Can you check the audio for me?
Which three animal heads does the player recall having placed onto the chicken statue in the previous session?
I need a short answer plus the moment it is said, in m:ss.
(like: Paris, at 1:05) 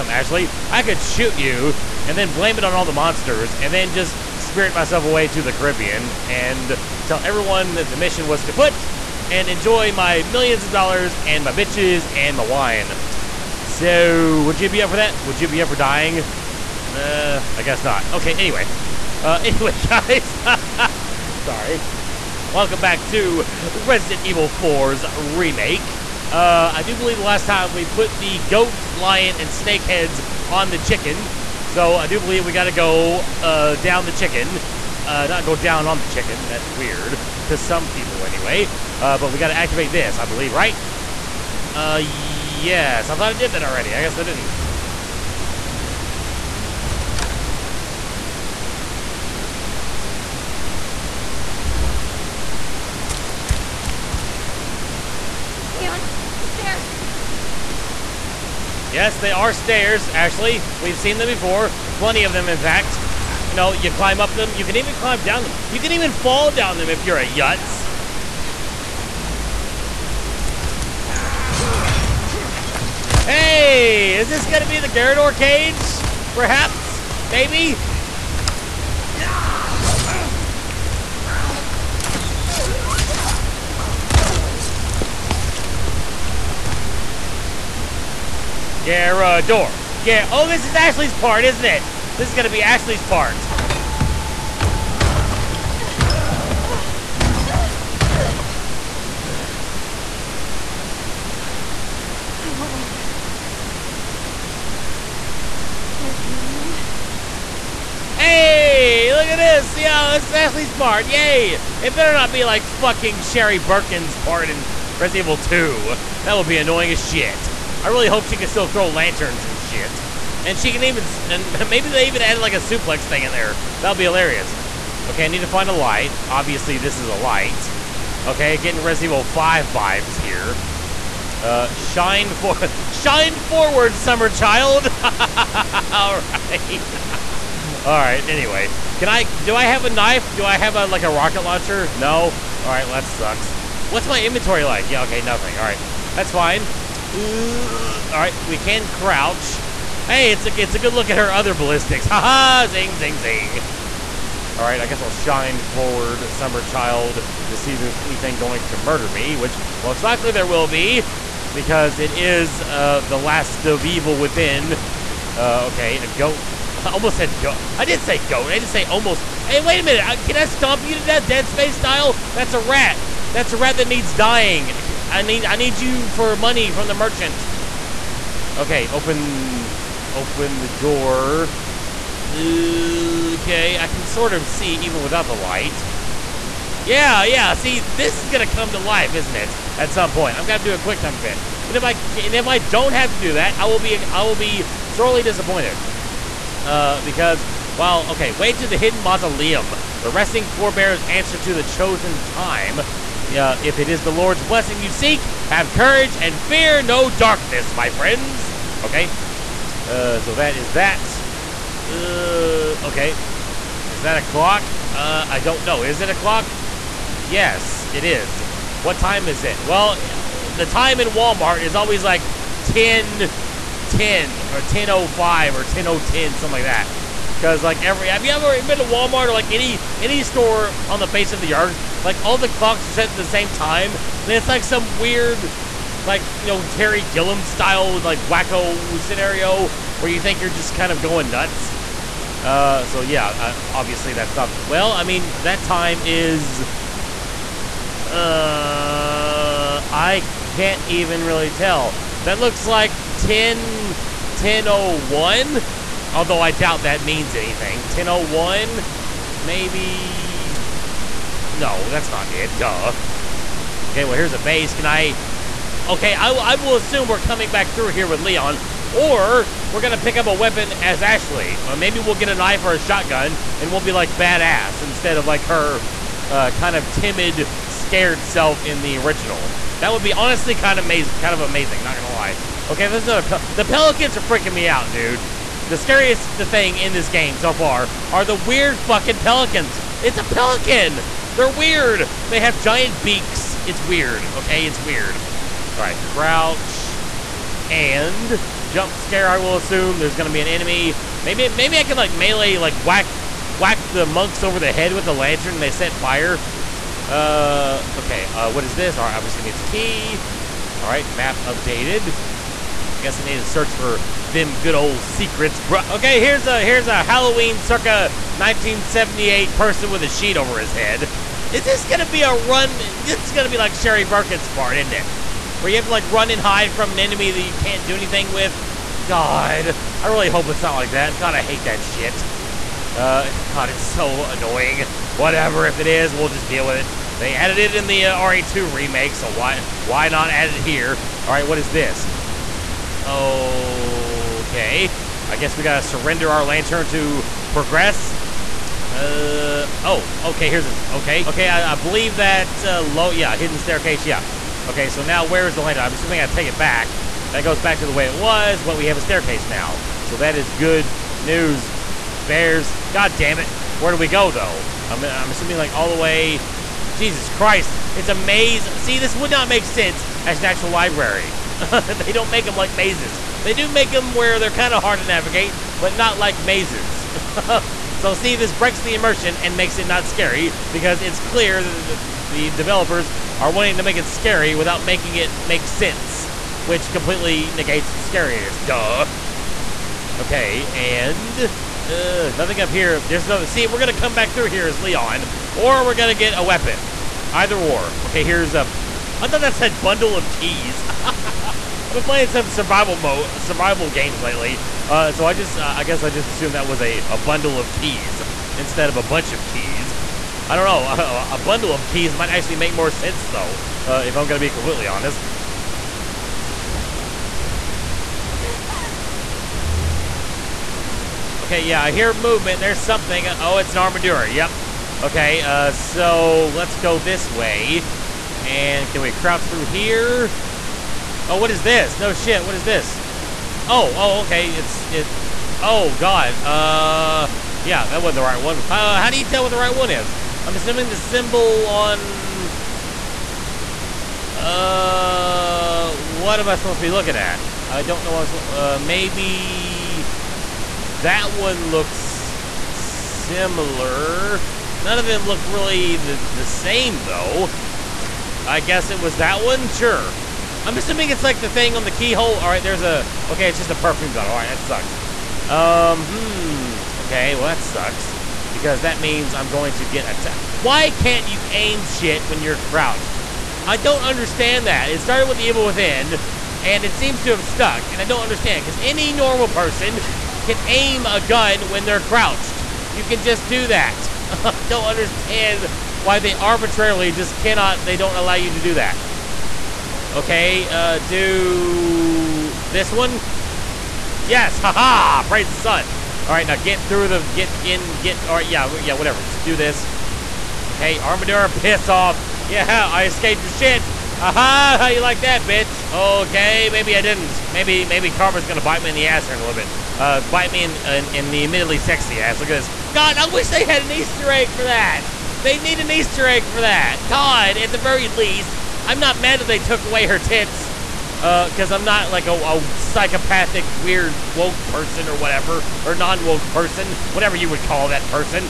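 goat, lion, and snake, at 0:28.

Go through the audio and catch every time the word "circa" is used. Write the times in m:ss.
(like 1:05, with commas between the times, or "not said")
5:17.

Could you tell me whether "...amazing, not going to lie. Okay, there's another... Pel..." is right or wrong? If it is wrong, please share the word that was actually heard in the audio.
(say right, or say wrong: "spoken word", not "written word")
right.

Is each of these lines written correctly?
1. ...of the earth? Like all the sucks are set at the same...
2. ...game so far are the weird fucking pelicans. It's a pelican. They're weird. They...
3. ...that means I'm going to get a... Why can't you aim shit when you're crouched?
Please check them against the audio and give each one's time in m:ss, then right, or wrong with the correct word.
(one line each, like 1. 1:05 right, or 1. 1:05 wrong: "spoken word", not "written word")
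1. 3:51 wrong: "clocks", not "sucks"
2. 4:47 right
3. 7:48 right.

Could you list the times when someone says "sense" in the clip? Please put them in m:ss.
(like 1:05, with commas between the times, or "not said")
6:09, 6:25, 6:52.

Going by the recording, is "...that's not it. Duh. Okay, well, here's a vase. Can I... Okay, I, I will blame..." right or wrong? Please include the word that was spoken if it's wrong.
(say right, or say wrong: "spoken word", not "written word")
wrong: "assume", not "blame".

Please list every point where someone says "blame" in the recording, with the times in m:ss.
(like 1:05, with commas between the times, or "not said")
0:02.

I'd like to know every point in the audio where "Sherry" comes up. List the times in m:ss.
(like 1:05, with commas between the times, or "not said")
1:53, 5:23.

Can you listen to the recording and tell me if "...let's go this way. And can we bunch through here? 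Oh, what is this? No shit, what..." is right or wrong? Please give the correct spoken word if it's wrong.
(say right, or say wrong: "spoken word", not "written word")
wrong: "crouch", not "bunch".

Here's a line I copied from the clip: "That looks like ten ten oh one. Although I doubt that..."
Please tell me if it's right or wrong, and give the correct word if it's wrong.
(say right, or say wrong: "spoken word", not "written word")
right.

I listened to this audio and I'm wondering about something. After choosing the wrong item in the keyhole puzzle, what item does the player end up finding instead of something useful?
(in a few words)
perfume bottle.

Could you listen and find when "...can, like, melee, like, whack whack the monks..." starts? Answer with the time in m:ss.
5:01.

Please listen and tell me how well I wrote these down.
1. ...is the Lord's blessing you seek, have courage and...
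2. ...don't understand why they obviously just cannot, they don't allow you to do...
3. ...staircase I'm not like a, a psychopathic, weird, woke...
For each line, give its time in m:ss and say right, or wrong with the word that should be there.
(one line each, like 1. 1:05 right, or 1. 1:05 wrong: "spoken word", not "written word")
1. 3:23 right
2. 8:04 wrong: "arbitrarily", not "obviously"
3. 8:41 wrong: "cause", not "staircase".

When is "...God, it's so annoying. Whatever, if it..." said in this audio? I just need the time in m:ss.
5:33.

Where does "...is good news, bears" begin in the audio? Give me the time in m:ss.
6:00.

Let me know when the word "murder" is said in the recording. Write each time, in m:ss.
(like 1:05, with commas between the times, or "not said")
2:38.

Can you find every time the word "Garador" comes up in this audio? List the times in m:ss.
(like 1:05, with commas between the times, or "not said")
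1:14, 1:28.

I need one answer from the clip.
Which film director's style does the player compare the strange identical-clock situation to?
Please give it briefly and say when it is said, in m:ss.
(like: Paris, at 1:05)
Terry Gilliam, at 3:56.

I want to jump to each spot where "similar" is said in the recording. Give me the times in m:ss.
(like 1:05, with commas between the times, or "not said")
7:32.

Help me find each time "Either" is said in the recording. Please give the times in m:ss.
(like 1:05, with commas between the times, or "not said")
6:37.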